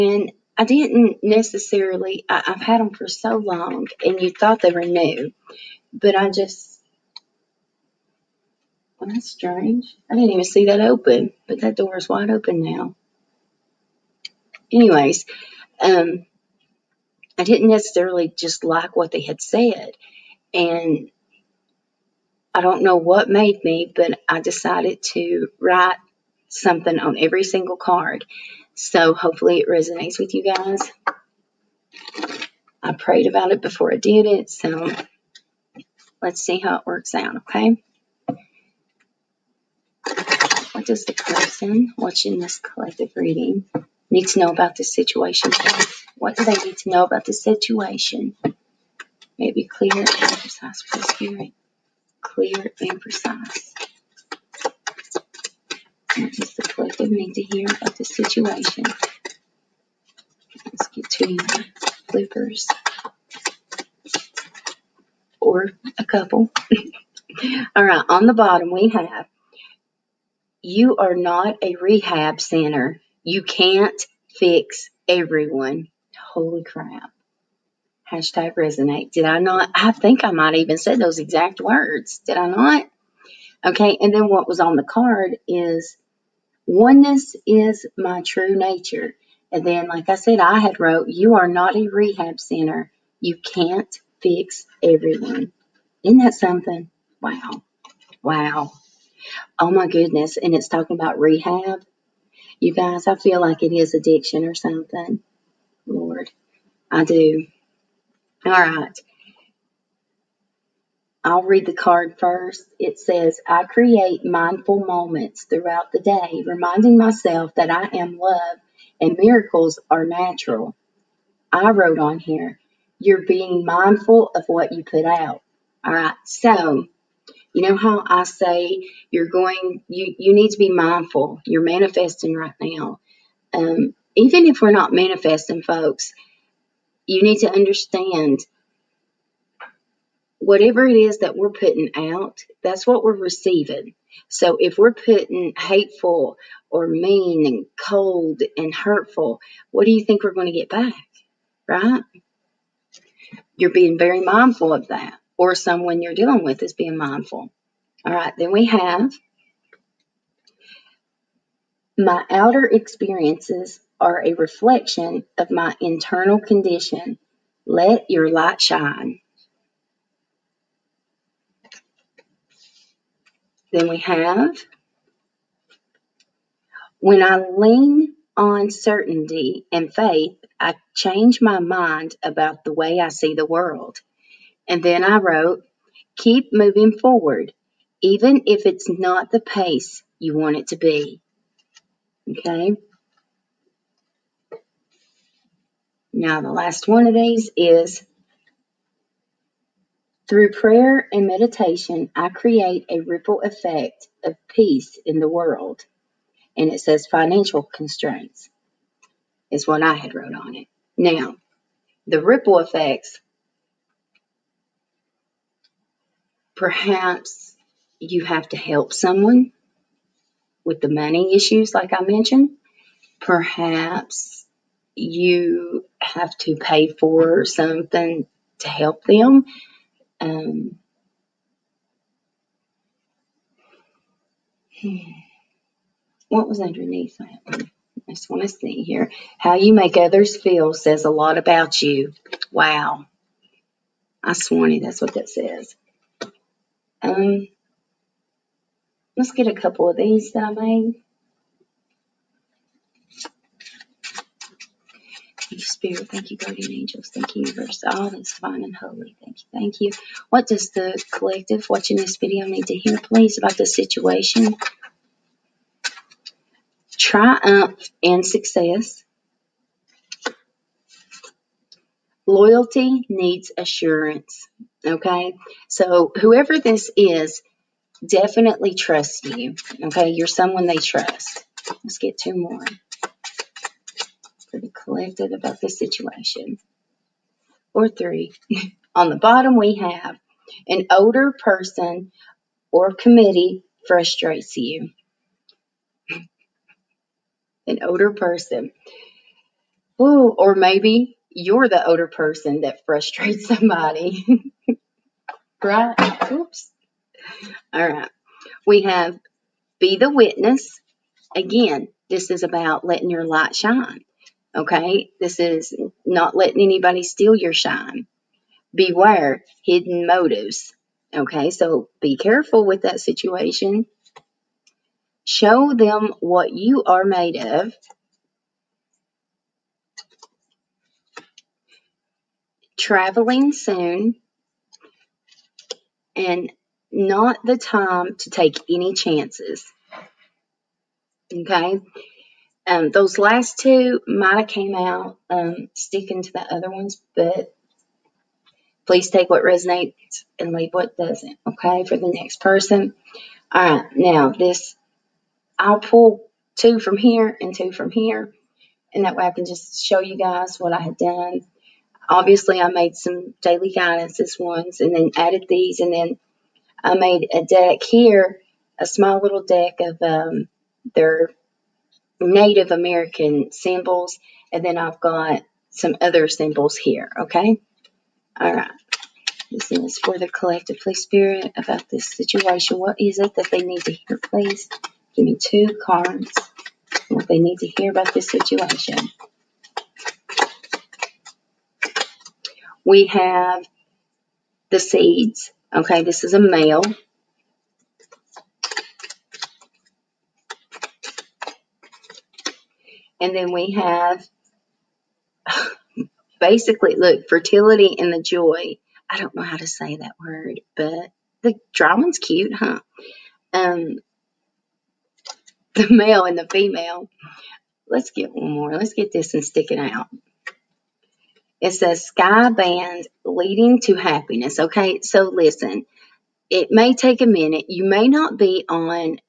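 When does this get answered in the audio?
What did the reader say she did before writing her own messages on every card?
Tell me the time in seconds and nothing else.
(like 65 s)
32 s.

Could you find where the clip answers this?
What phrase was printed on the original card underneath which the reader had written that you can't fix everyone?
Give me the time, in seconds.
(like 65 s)
86 s.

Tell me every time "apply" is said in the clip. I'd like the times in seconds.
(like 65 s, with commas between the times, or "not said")
not said.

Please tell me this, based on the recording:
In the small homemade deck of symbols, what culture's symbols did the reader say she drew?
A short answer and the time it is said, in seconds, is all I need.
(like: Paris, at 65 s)
Native American, at 372 s.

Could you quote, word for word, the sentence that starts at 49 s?
May it be clear and precise for the spirit.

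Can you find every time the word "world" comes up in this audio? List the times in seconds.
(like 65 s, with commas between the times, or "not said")
183 s, 205 s.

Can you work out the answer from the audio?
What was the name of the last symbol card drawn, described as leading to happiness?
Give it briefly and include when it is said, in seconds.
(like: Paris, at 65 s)
Sky band, at 422 s.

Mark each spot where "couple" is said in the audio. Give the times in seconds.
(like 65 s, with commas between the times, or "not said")
66 s, 249 s.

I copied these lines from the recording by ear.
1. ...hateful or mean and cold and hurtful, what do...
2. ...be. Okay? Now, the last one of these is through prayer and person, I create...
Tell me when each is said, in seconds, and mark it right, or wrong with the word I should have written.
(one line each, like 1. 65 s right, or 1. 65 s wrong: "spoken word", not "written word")
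1. 145 s right
2. 190 s wrong: "meditation", not "person".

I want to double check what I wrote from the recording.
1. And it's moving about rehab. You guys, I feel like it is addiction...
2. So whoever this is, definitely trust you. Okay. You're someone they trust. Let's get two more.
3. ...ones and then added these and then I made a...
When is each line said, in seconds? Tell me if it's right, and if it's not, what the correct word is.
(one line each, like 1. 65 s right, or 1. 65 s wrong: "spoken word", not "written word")
1. 100 s wrong: "talking", not "moving"
2. 275 s right
3. 364 s right.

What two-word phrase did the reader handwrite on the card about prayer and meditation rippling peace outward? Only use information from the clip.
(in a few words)
Financial constraints.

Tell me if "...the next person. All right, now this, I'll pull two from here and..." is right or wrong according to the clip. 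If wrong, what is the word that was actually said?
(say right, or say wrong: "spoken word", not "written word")
right.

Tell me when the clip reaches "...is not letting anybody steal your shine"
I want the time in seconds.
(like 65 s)
315 s.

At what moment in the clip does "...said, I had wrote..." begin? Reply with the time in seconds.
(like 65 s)
90 s.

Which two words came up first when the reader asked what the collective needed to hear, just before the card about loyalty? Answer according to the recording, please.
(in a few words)
Triumph and success.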